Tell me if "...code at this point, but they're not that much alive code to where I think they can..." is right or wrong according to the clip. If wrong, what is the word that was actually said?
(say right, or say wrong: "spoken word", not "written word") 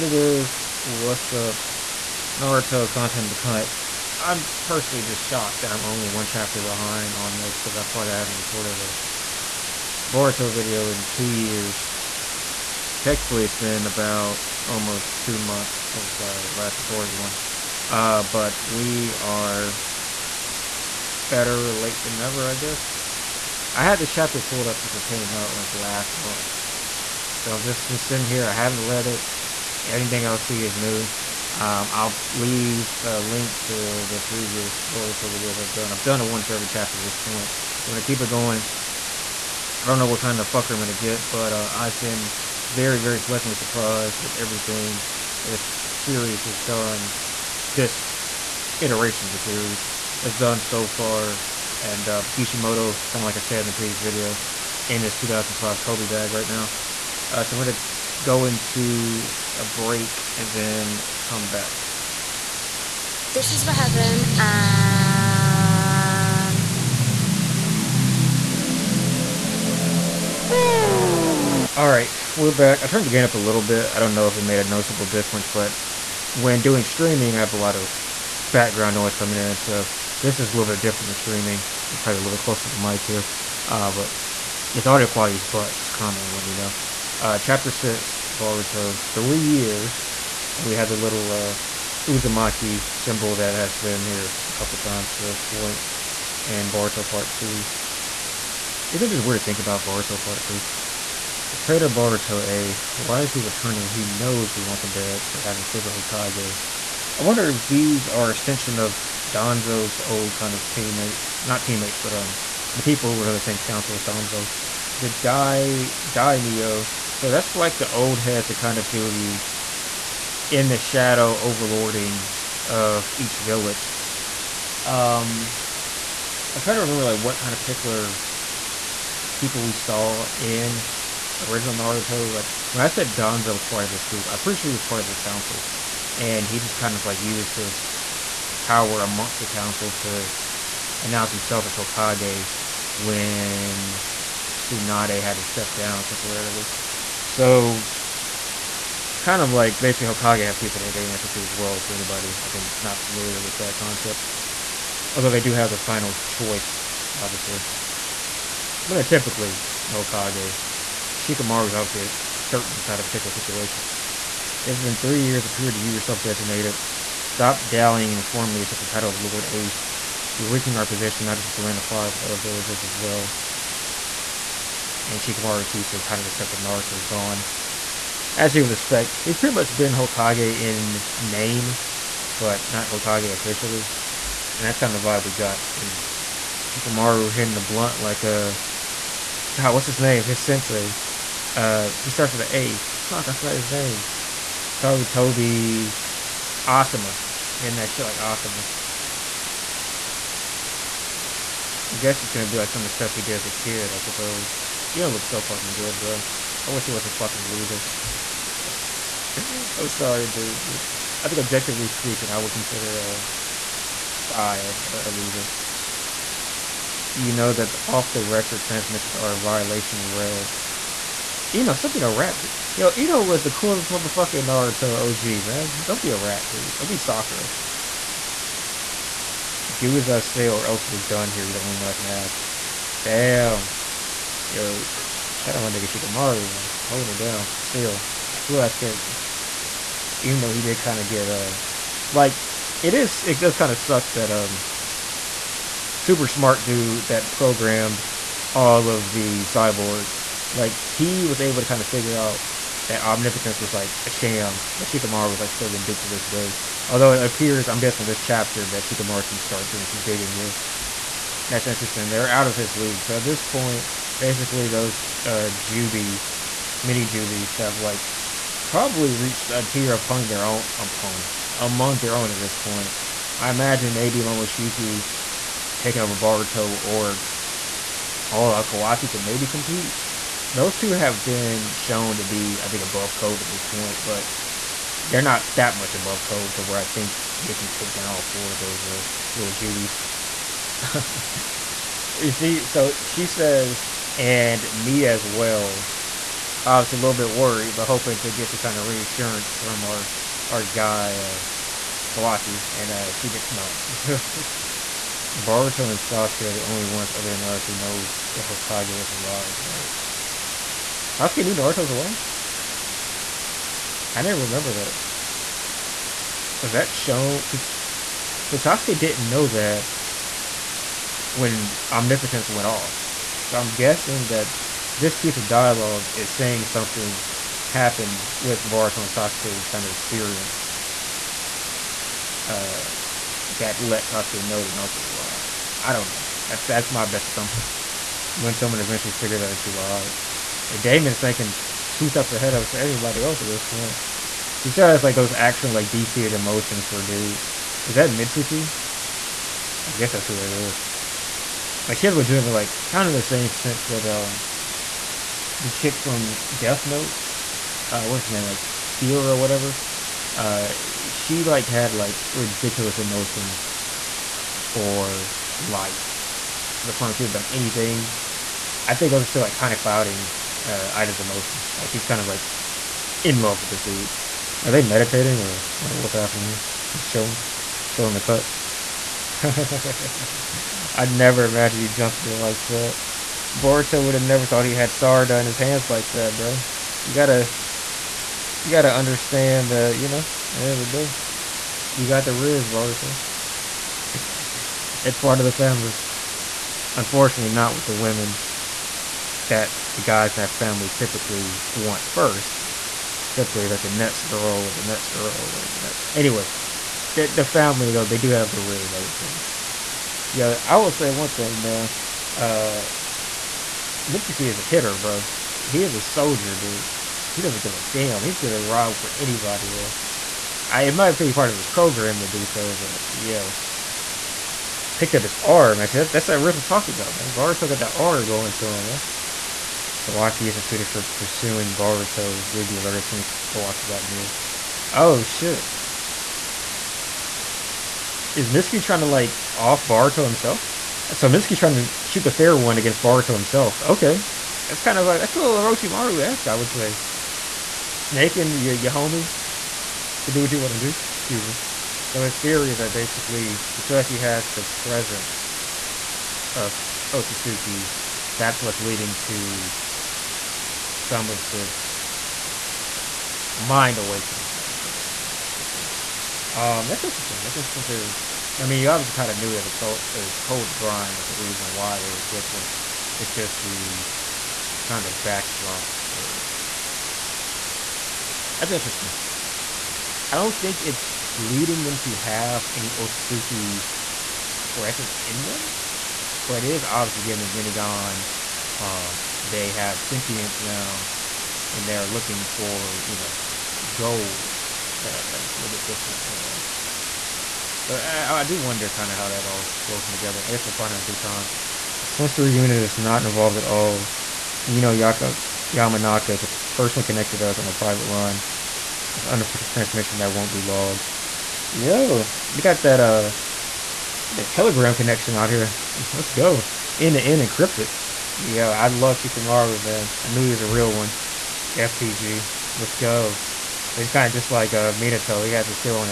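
wrong: "above", not "alive".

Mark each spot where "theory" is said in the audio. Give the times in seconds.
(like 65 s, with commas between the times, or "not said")
452 s, 467 s.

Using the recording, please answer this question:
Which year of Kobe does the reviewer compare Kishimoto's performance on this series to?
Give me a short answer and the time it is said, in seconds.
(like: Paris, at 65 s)
2005, at 55 s.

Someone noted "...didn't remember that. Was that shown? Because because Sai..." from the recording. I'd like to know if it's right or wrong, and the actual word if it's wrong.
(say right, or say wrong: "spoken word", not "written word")
wrong: "Sasuke", not "Sai".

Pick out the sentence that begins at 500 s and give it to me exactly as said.
I guess we'll find out in due time.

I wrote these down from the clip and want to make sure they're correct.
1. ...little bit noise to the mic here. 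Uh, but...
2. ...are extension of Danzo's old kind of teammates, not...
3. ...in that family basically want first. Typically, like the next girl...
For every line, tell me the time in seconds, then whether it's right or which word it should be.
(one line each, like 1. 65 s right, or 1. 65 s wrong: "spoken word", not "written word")
1. 82 s wrong: "close", not "noise"
2. 108 s right
3. 400 s wrong: "typically", not "basically".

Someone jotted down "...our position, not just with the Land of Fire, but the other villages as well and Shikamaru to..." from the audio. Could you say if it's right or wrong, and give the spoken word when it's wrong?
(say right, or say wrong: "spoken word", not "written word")
right.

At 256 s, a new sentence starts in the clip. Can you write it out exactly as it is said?
Although it appears, I'm guessing with this chapter, that Shikamaru's going to start doing some digging here.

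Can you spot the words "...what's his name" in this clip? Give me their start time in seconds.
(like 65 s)
189 s.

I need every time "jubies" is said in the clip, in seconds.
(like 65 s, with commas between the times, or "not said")
267 s, 289 s.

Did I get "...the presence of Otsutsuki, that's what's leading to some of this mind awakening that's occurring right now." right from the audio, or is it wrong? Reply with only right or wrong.
right.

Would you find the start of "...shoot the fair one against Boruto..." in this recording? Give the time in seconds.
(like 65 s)
442 s.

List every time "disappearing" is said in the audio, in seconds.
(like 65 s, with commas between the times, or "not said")
not said.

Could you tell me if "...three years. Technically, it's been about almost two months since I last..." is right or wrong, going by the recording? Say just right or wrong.
wrong.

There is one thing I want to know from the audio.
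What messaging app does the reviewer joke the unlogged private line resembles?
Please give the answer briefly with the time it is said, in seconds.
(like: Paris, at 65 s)
Telegram, at 514 s.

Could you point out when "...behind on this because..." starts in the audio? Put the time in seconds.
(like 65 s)
6 s.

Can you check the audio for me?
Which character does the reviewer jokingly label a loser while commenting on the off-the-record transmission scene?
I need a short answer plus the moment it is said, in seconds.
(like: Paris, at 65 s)
Sai, at 214 s.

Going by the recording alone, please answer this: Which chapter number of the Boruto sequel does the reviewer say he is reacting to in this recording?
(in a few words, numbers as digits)
6.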